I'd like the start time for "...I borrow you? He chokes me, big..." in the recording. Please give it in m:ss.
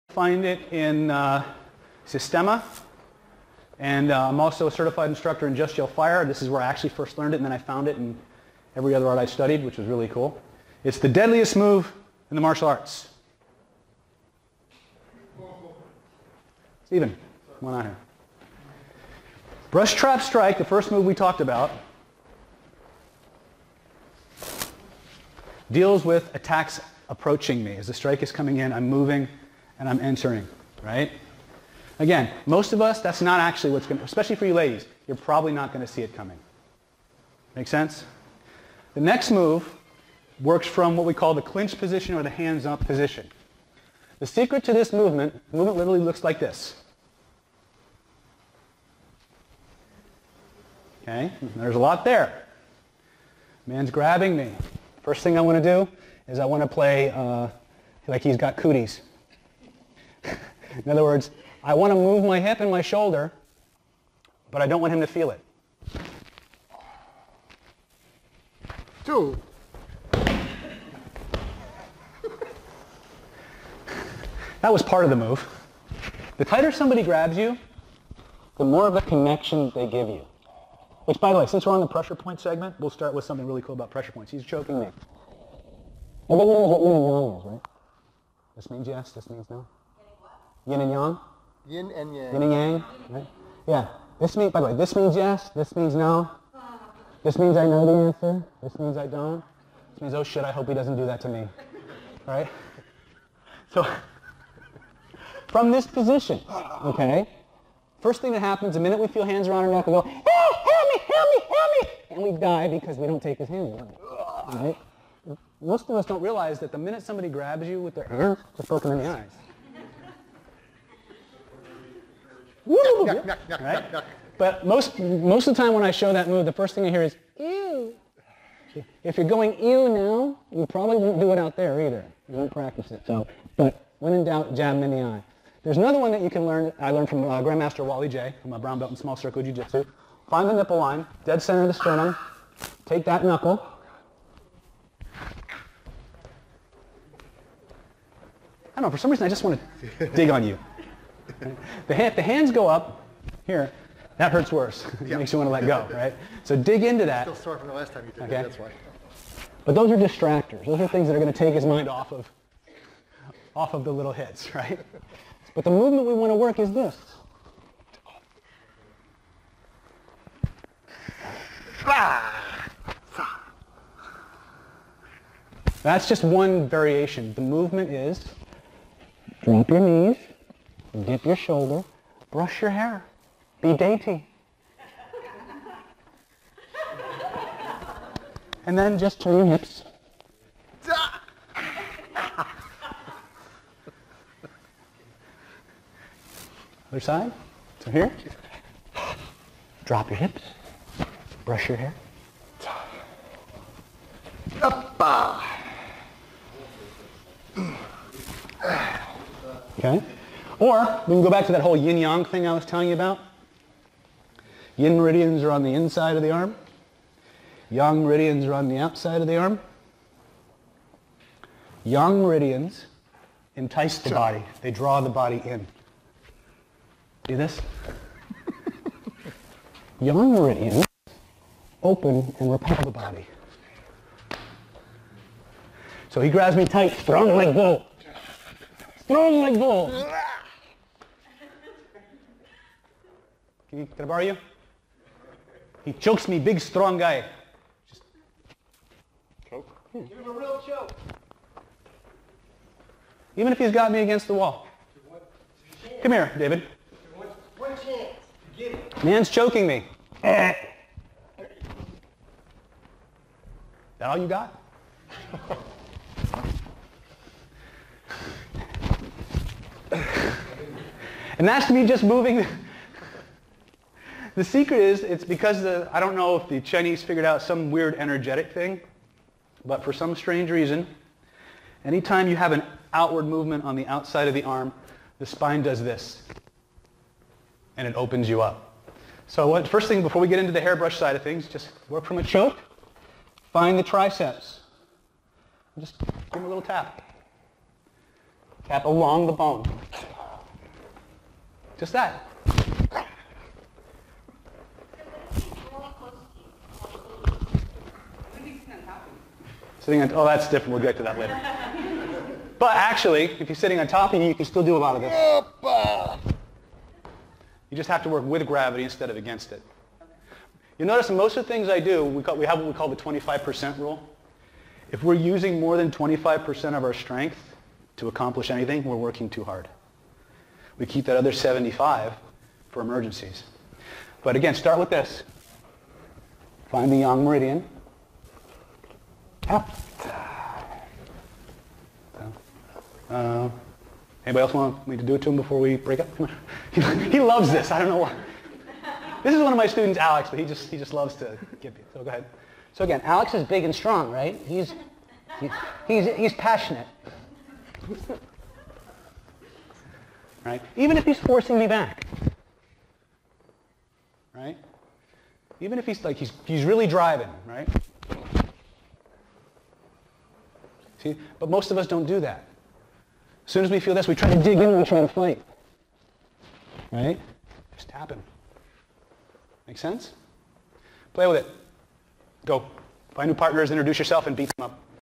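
4:03.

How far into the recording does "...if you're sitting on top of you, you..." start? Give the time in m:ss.
5:13.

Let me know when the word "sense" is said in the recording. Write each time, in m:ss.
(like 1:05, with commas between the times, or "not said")
0:37, 6:19.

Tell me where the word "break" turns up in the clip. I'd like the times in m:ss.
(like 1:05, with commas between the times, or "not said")
5:45.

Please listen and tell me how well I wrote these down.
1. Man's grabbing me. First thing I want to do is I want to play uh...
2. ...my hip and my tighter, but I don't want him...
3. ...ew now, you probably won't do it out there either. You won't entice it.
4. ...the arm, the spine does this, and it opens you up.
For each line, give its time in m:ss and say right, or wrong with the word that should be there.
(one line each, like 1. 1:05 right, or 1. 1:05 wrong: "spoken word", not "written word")
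1. 0:53 right
2. 1:02 wrong: "shoulder", not "tighter"
3. 2:09 wrong: "practice", not "entice"
4. 4:44 right.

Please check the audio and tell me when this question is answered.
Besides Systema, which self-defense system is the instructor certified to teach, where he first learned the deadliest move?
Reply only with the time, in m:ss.
0:05.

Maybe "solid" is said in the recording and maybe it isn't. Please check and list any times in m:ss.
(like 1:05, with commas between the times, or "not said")
not said.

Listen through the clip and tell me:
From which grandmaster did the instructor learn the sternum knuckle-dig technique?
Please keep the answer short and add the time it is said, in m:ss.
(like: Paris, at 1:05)
Wally Jay, at 2:17.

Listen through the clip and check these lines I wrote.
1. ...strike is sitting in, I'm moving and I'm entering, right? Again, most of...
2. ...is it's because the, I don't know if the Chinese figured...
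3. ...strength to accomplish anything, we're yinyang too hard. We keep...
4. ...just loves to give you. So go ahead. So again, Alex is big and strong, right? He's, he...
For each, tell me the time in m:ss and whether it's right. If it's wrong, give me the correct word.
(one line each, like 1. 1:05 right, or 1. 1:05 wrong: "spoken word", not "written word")
1. 0:27 wrong: "coming", not "sitting"
2. 4:34 right
3. 5:26 wrong: "working", not "yinyang"
4. 5:50 right.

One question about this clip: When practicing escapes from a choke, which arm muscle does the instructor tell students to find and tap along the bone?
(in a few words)
triceps.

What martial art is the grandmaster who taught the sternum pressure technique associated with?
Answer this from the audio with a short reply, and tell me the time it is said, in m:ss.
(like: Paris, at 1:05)
small circle jiu-jitsu, at 2:18.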